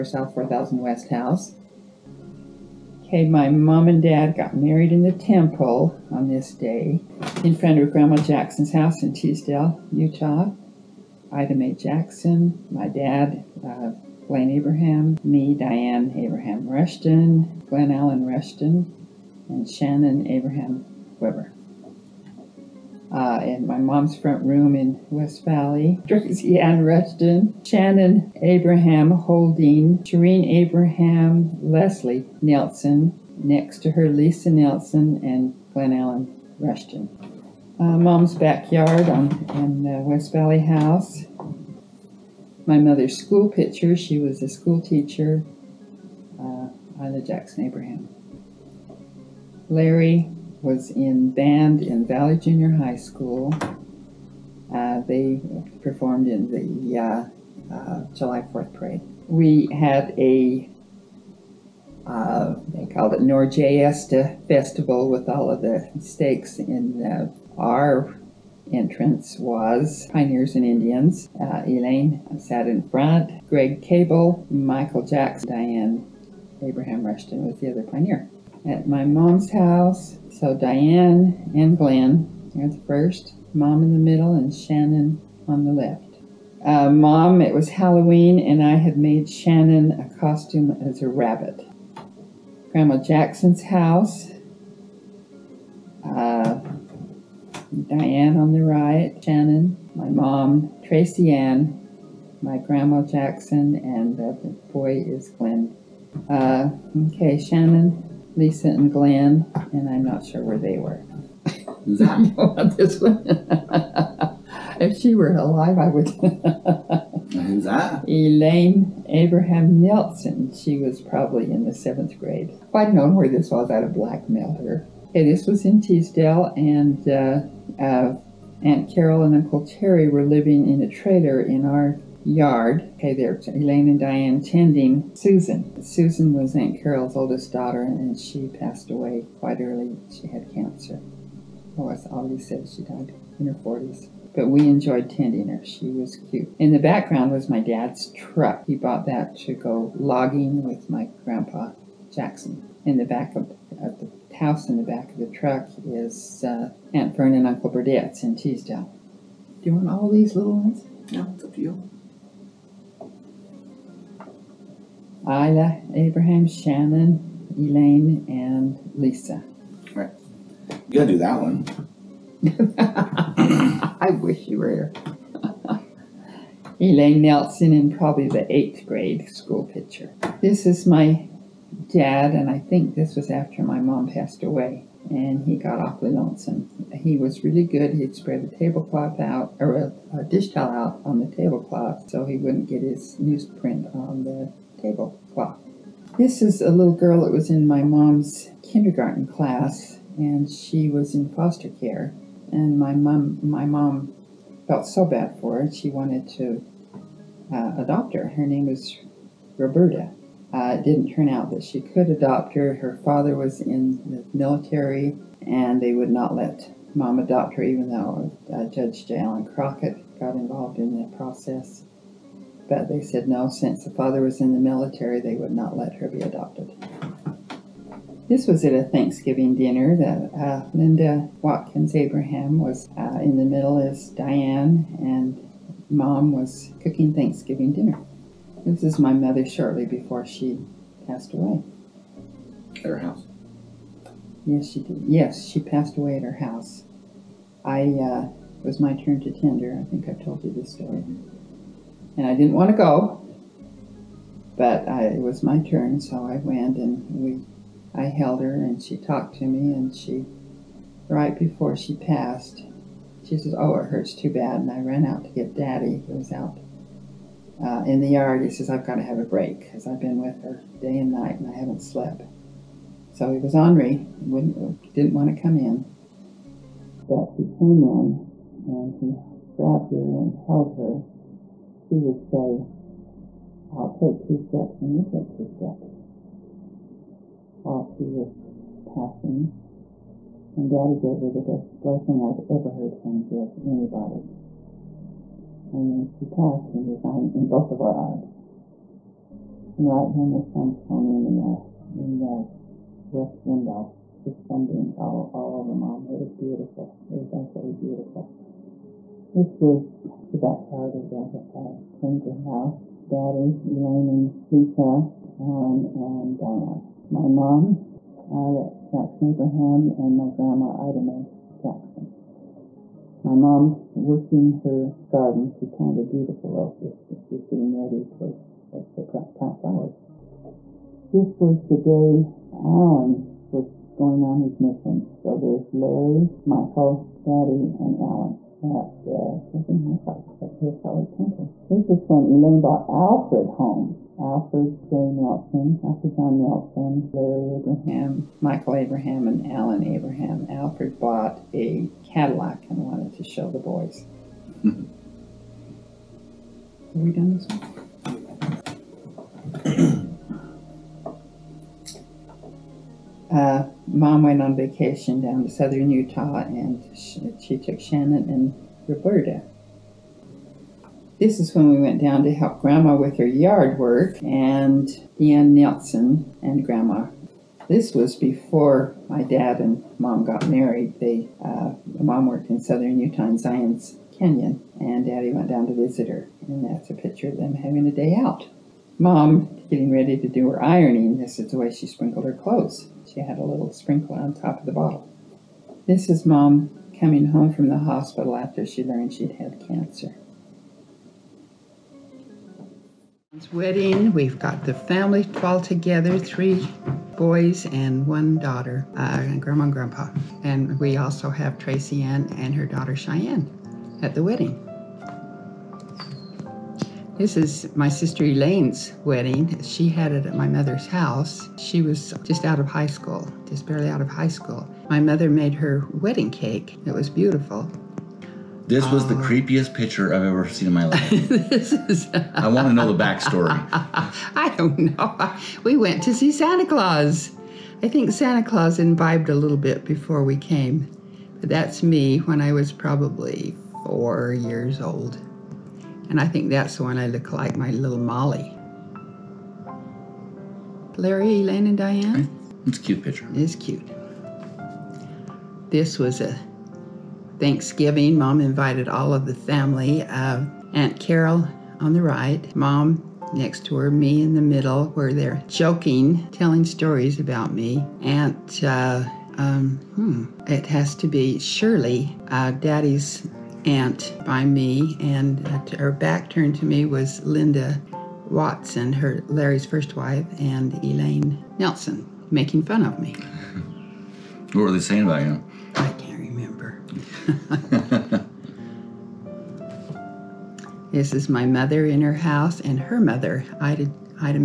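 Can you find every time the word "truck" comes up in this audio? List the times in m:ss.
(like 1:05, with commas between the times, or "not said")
2:28, 2:35.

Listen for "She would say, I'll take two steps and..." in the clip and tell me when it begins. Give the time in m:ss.
4:41.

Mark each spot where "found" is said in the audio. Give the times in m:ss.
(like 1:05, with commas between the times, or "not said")
not said.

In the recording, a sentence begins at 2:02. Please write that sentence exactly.
If I'd known where this was, I'd have blackmailed her.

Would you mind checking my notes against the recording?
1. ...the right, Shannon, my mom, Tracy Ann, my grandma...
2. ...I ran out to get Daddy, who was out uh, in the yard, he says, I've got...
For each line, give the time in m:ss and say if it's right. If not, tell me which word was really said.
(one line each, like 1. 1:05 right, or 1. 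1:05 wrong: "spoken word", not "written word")
1. 1:38 right
2. 4:24 right.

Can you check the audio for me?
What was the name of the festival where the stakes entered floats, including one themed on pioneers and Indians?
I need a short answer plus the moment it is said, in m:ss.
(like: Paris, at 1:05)
Norjesta Festival, at 1:03.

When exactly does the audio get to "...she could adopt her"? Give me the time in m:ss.
3:31.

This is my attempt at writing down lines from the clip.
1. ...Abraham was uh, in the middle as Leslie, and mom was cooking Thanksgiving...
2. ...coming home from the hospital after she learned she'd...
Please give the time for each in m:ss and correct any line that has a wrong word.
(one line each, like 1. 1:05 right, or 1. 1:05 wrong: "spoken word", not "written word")
1. 3:51 wrong: "Diane", not "Leslie"
2. 6:36 right.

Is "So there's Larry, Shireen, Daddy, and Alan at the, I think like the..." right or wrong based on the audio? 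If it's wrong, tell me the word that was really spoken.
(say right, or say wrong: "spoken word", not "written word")
wrong: "Michael", not "Shireen".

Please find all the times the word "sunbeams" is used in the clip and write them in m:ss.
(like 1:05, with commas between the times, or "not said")
5:04.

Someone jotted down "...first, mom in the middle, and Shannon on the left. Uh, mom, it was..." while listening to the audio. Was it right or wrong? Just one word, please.
right.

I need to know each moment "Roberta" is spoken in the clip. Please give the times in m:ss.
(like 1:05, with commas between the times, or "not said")
3:29, 6:08.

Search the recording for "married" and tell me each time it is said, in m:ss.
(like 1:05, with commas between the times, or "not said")
0:04, 6:20.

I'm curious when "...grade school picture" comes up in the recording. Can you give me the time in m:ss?
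2:58.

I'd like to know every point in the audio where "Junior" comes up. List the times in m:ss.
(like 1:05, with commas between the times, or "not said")
0:52.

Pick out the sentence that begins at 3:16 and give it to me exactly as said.
This is a little girl that was in my mom's kindergarten class, and she was in foster care.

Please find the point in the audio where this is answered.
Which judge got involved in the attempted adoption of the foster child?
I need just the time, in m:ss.
3:39.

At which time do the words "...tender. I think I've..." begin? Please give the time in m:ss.
4:09.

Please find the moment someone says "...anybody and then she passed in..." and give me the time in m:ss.
4:53.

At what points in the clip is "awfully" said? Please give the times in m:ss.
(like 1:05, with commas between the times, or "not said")
3:05.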